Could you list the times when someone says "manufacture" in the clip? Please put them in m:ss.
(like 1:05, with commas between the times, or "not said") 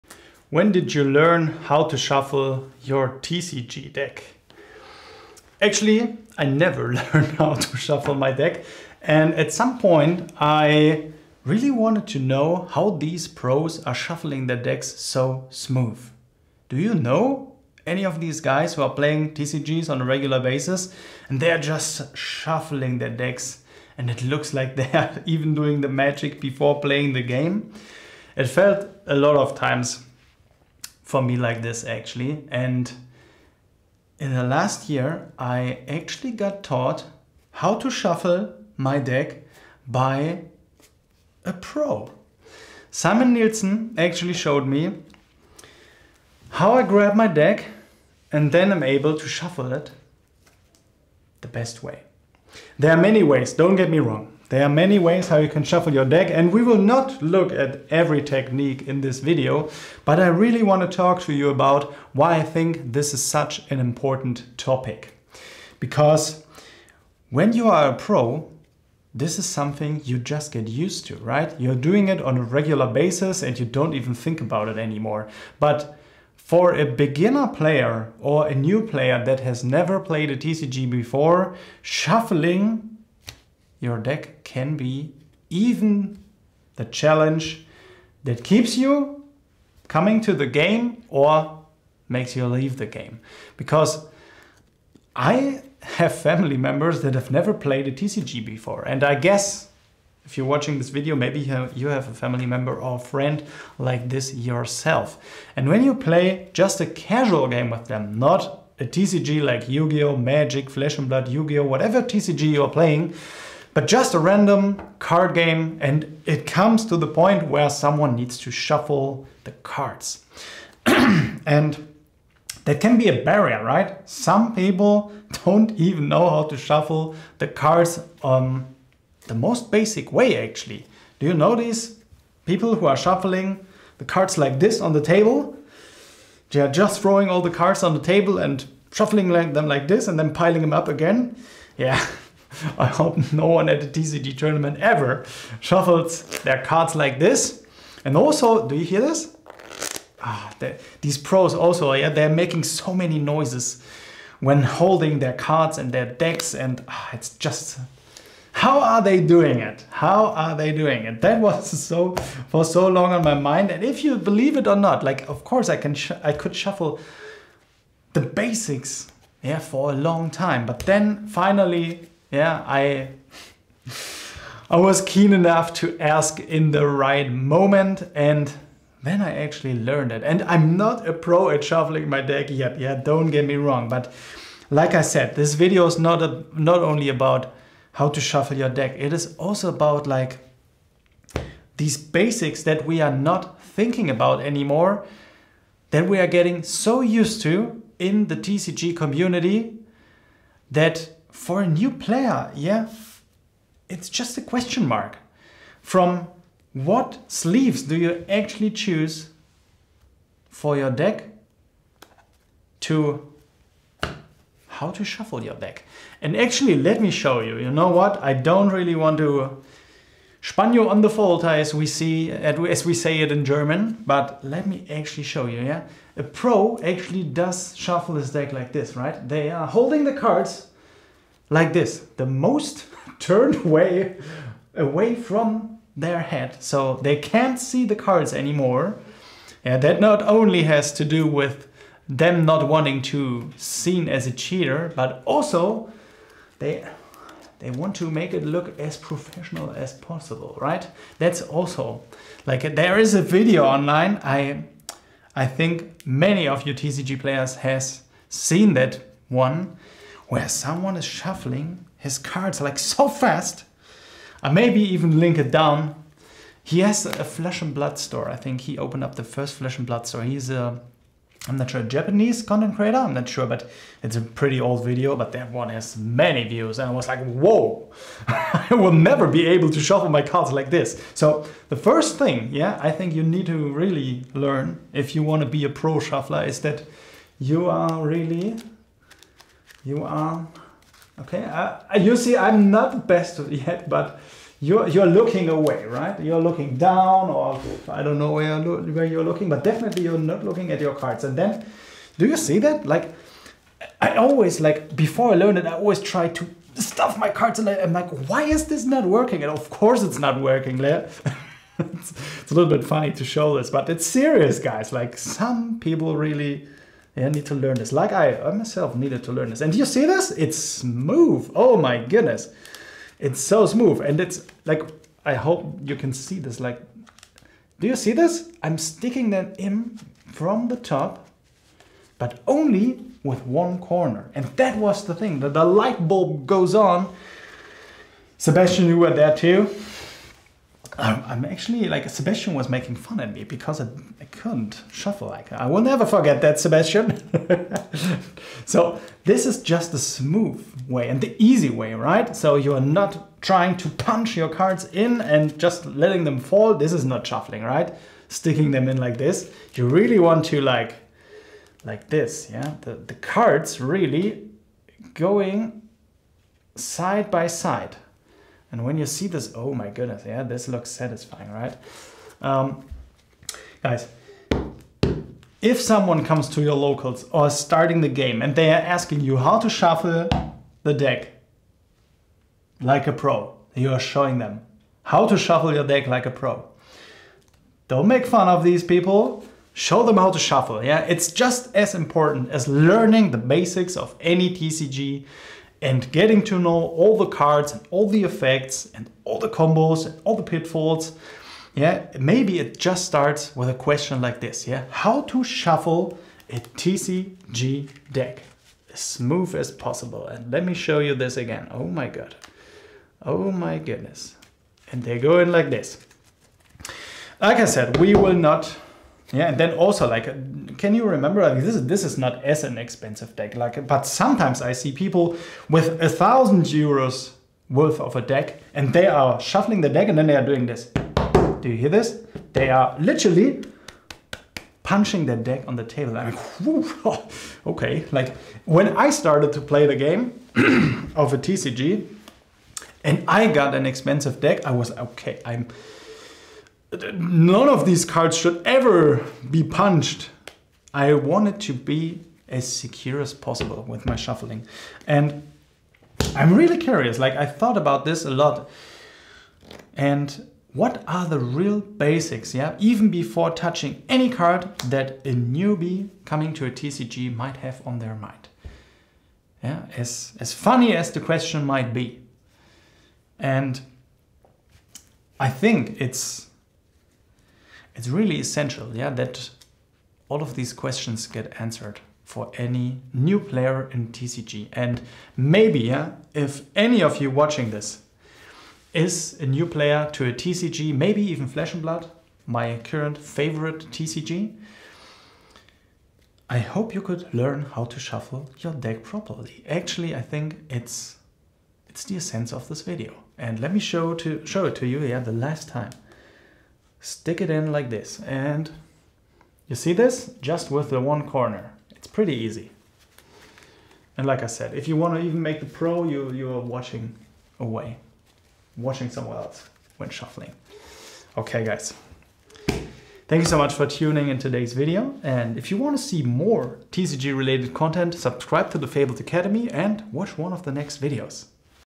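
not said.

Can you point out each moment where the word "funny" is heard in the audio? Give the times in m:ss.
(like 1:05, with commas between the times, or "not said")
5:12, 7:50.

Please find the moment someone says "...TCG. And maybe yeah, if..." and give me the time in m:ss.
8:04.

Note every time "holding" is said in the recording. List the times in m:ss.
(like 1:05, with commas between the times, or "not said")
2:34, 3:49.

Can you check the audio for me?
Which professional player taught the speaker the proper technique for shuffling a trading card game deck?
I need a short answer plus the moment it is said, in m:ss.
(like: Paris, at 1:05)
Simon Nielsen, at 0:42.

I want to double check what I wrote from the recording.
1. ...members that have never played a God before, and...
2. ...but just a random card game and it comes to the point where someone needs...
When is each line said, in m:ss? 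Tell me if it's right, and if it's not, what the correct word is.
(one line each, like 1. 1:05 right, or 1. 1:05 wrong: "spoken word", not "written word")
1. 1:36 wrong: "TCG", not "God"
2. 1:53 right.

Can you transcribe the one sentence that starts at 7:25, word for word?
I'm none of these cards should ever be punched.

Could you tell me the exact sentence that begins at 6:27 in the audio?
Don't make fun of these people.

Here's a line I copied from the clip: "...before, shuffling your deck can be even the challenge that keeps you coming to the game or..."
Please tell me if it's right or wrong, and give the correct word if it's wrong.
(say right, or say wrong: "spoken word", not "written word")
right.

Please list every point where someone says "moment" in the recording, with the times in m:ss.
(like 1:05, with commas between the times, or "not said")
2:57.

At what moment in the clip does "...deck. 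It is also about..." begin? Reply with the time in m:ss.
3:08.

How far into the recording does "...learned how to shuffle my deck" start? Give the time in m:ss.
0:06.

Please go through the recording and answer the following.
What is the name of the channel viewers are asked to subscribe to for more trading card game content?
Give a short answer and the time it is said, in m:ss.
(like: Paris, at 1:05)
Fabled Academy, at 8:48.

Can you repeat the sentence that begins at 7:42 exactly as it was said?
Even before touching any card that a newbie coming to a TCG might have on their mind.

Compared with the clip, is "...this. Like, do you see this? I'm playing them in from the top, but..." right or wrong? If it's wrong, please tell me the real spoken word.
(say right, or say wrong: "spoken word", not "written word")
wrong: "sticking", not "playing".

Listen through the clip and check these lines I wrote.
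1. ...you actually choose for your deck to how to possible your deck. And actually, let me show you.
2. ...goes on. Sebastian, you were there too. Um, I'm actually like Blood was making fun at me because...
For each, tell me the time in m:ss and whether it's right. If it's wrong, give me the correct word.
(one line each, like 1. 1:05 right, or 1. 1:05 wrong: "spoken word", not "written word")
1. 3:27 wrong: "shuffle", not "possible"
2. 5:36 wrong: "Sebastian", not "Blood".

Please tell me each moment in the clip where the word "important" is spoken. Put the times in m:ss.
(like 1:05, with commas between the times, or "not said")
1:03, 6:31.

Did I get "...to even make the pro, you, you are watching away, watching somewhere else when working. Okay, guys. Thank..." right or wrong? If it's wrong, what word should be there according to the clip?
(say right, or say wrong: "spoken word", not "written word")
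wrong: "shuffling", not "working".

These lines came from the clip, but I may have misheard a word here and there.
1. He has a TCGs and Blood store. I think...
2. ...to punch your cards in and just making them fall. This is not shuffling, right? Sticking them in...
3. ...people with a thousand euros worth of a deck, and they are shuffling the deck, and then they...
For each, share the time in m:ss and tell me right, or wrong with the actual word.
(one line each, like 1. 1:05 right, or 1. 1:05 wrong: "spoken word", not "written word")
1. 4:26 wrong: "Flesh", not "TCGs"
2. 5:53 wrong: "letting", not "making"
3. 7:04 right.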